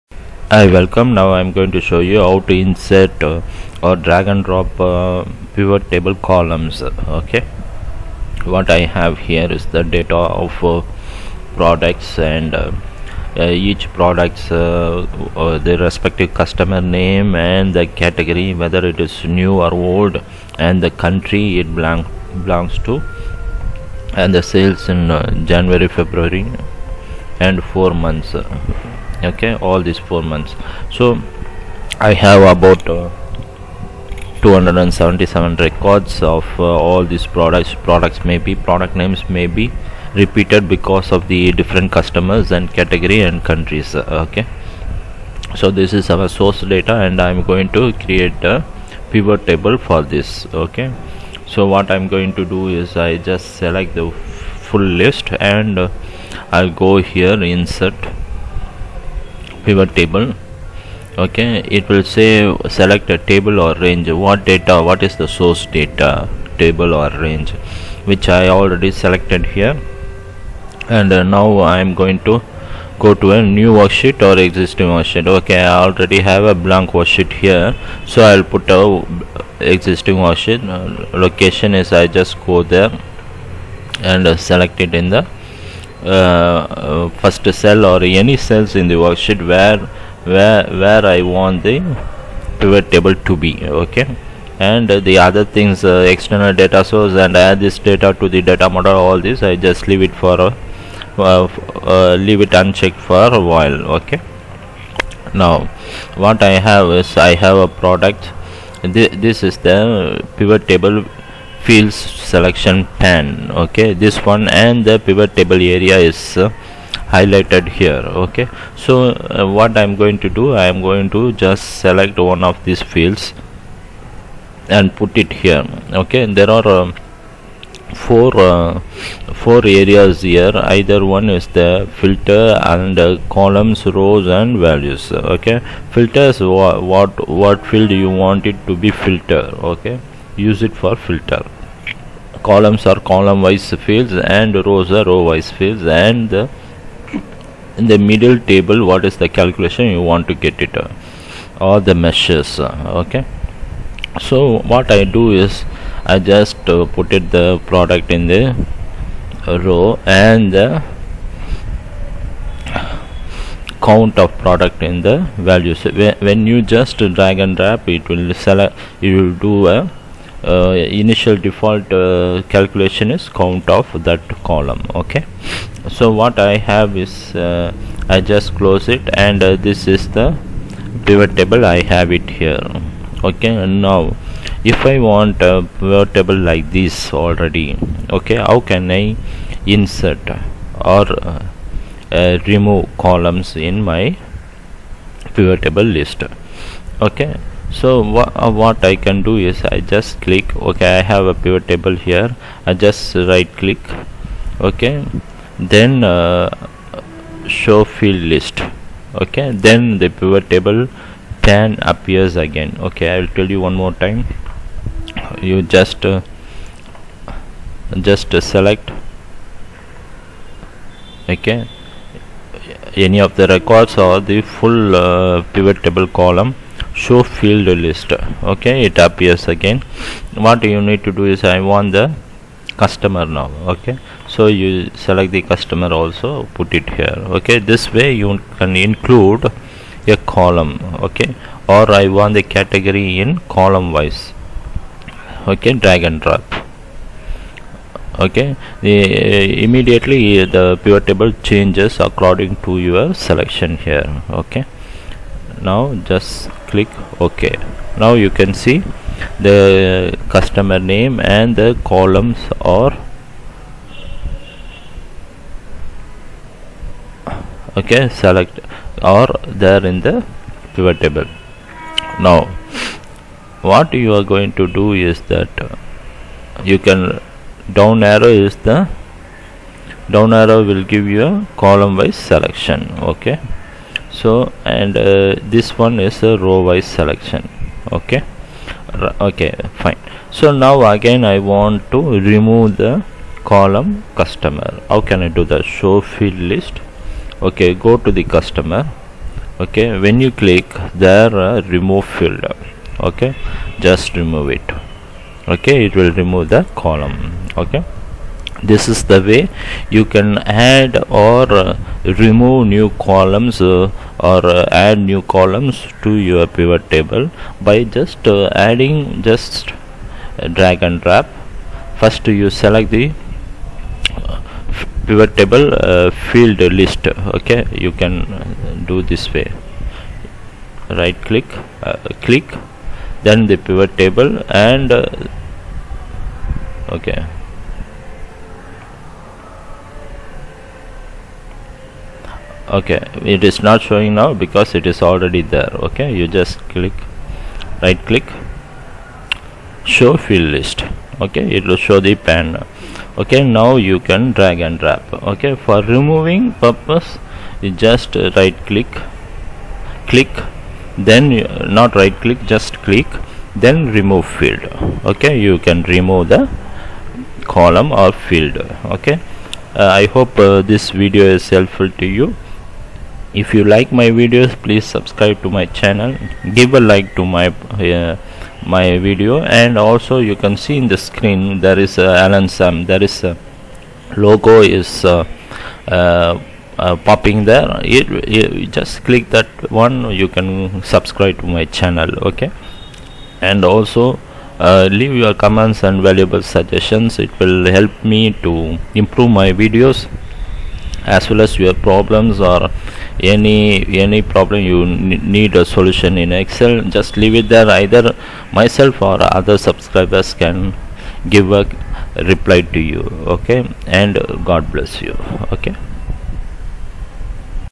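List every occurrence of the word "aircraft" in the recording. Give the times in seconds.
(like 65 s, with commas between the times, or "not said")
not said.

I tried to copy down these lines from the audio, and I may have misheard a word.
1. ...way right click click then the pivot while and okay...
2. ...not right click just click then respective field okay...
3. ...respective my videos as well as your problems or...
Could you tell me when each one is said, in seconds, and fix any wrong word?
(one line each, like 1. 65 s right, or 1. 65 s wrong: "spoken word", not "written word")
1. 329 s wrong: "table", not "while"
2. 361 s wrong: "remove", not "respective"
3. 398 s wrong: "improve", not "respective".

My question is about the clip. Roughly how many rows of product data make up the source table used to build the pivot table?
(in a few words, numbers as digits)
277.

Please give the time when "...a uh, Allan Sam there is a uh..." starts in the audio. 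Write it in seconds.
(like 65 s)
381 s.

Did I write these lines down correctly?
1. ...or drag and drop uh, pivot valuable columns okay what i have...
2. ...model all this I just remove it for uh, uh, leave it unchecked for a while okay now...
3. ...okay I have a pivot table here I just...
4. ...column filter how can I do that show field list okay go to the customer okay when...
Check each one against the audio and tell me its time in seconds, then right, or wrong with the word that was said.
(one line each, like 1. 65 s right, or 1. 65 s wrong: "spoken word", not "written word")
1. 3 s wrong: "table", not "valuable"
2. 98 s wrong: "leave", not "remove"
3. 200 s right
4. 293 s wrong: "customer", not "filter".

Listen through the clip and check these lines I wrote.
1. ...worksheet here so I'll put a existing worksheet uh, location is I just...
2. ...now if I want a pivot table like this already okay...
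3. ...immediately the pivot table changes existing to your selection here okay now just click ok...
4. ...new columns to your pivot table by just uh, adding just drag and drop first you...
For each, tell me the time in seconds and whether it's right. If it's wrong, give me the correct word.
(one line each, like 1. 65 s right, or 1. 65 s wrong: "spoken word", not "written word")
1. 76 s right
2. 183 s right
3. 249 s wrong: "according", not "existing"
4. 314 s right.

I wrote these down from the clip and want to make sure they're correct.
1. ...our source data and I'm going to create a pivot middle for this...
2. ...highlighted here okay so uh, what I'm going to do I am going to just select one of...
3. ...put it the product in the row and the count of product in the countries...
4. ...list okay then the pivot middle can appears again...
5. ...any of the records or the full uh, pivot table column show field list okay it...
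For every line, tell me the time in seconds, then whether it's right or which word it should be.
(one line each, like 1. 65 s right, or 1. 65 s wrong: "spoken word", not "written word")
1. 46 s wrong: "table", not "middle"
2. 117 s right
3. 156 s wrong: "values", not "countries"
4. 208 s wrong: "table", not "middle"
5. 222 s right.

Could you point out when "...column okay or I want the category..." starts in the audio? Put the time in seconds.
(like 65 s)
240 s.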